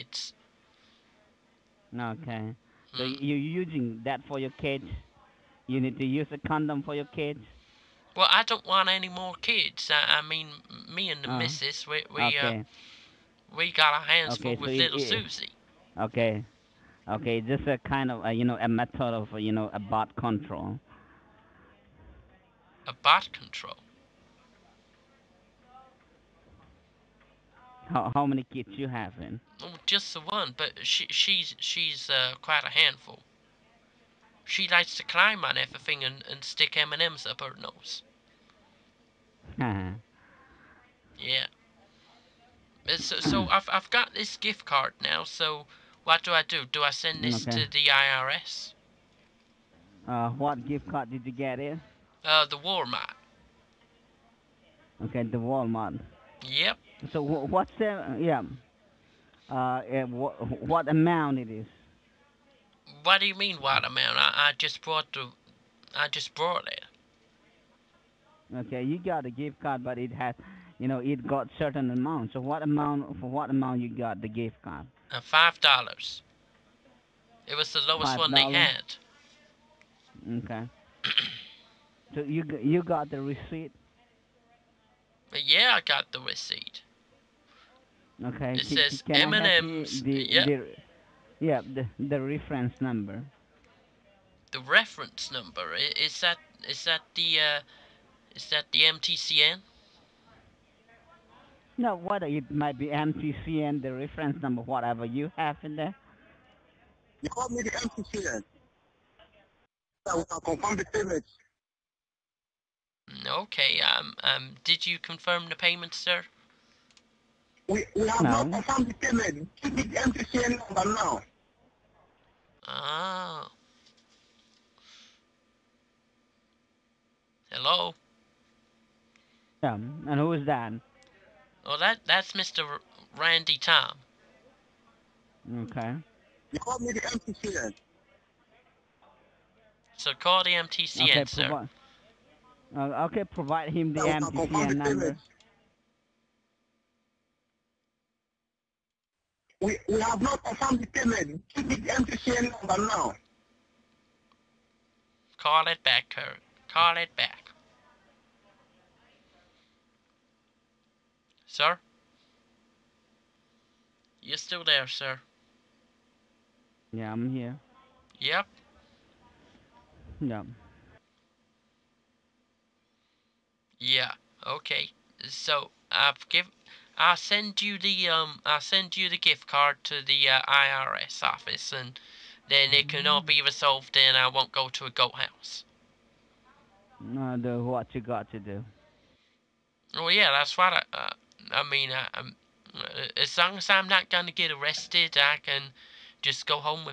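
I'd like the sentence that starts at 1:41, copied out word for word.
know what it might be MCCN, the reference number, whatever you have in there.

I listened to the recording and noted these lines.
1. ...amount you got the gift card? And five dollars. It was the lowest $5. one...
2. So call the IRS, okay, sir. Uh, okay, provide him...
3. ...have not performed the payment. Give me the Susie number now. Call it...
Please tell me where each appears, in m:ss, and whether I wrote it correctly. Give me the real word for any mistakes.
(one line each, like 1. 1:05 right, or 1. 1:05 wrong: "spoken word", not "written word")
1. 1:13 right
2. 2:19 wrong: "MTCN", not "IRS"
3. 2:30 wrong: "MTCN", not "Susie".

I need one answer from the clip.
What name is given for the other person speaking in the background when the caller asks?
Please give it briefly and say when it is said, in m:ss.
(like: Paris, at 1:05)
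Randy Tom, at 2:13.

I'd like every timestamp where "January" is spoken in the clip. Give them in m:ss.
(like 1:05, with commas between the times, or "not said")
not said.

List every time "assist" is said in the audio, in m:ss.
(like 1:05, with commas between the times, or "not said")
not said.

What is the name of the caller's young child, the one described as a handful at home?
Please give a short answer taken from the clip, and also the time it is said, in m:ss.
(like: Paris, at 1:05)
Susie, at 0:15.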